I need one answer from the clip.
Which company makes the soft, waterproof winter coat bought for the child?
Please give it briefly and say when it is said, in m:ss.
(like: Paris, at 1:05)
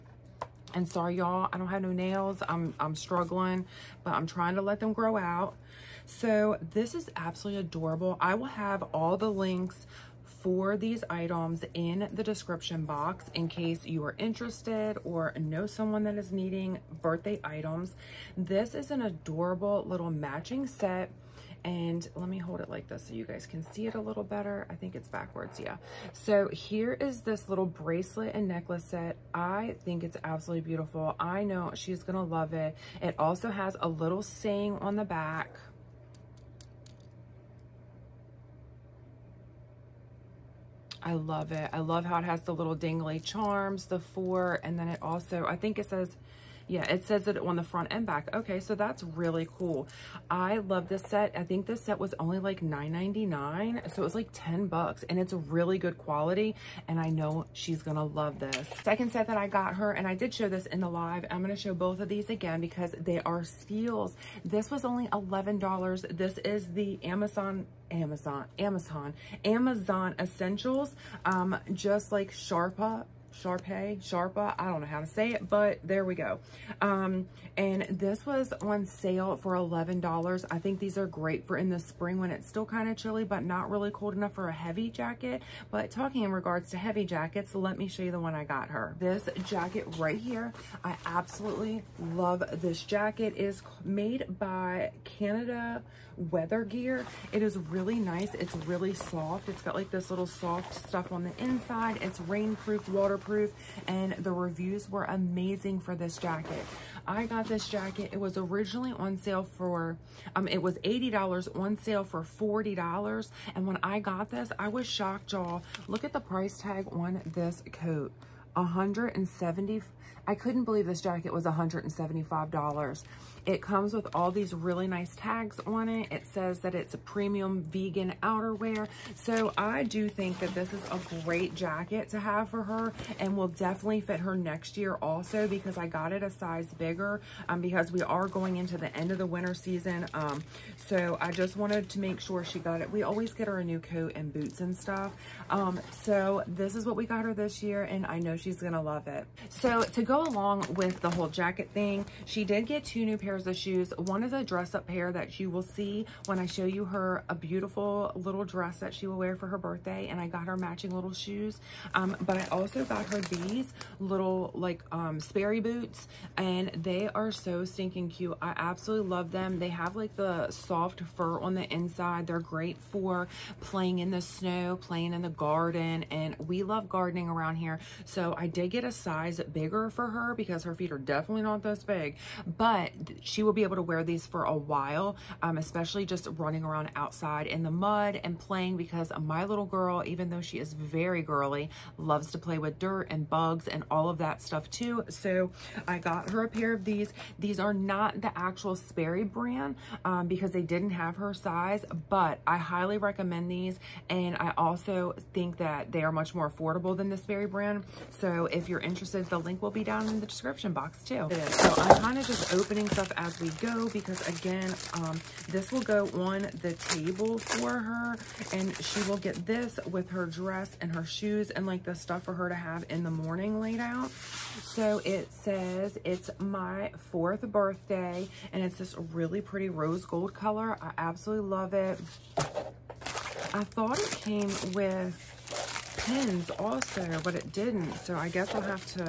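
Canada Weather Gear, at 1:35.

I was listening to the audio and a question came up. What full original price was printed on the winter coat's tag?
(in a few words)
$175.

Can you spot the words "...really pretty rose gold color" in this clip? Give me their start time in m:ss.
3:49.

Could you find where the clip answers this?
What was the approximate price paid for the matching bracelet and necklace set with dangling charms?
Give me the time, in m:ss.
0:52.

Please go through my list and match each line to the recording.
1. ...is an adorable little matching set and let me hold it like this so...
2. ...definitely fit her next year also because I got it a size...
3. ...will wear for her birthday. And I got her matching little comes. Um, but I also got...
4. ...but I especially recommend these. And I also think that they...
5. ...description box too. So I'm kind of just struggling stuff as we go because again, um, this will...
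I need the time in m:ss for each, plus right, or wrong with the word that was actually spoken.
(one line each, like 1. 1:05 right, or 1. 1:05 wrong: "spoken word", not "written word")
1. 0:18 right
2. 2:13 right
3. 2:39 wrong: "shoes", not "comes"
4. 3:22 wrong: "highly", not "especially"
5. 3:30 wrong: "opening", not "struggling".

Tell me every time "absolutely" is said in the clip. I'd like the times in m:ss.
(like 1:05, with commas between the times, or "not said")
0:07, 0:30, 1:31, 2:48, 3:50.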